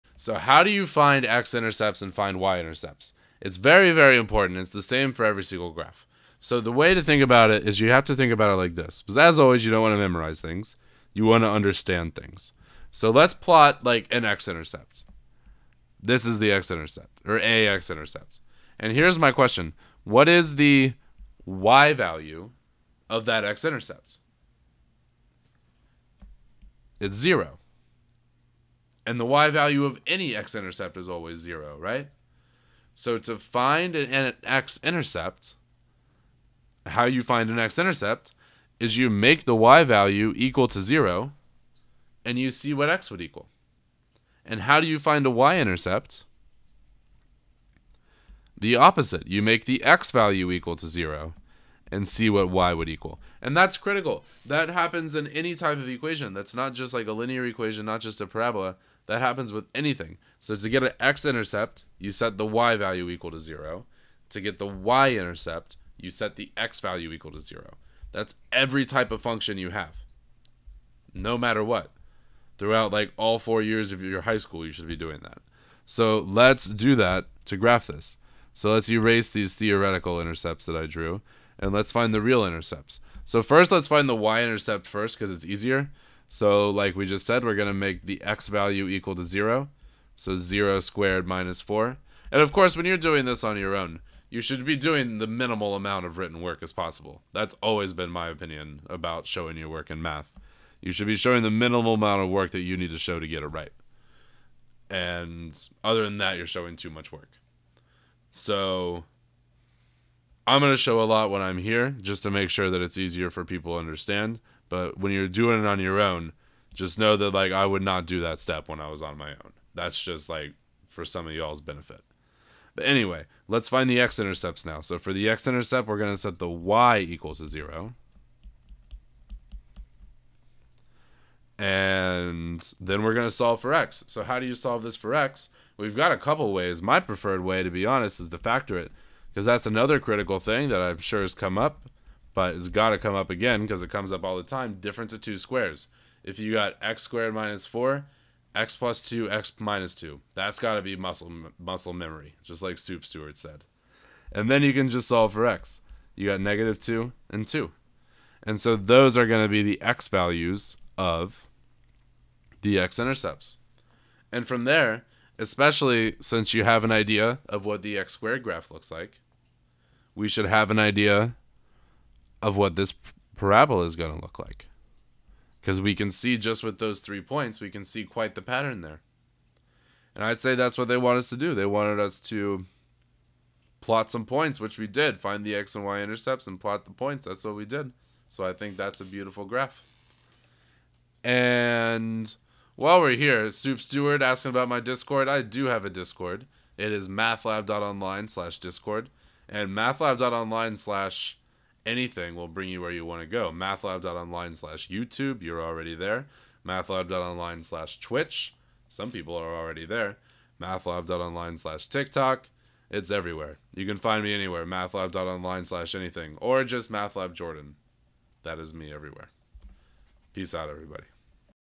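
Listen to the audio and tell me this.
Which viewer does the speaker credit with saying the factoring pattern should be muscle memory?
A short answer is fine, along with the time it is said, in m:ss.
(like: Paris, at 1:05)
Soup Stewart, at 2:32.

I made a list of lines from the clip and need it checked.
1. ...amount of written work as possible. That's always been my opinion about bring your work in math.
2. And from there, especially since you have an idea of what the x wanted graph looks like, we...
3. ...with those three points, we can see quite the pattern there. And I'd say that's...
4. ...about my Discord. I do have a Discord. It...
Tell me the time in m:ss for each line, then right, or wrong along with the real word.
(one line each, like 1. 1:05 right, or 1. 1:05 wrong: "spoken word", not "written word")
1. 1:35 wrong: "showing", not "bring"
2. 2:44 wrong: "squared", not "wanted"
3. 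2:56 right
4. 3:14 right.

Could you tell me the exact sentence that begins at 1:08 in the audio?
That's every type of function you have.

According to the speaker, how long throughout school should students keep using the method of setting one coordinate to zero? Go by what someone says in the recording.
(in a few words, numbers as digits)
all 4 years.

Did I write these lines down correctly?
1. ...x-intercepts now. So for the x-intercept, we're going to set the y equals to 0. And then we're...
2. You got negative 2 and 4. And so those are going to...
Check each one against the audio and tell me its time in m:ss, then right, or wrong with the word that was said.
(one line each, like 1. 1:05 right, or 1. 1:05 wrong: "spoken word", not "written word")
1. 2:03 right
2. 2:36 wrong: "2", not "4".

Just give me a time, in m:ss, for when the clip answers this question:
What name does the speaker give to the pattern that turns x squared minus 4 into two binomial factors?
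2:24.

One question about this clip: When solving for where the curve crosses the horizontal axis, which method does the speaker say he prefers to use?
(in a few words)
factor it.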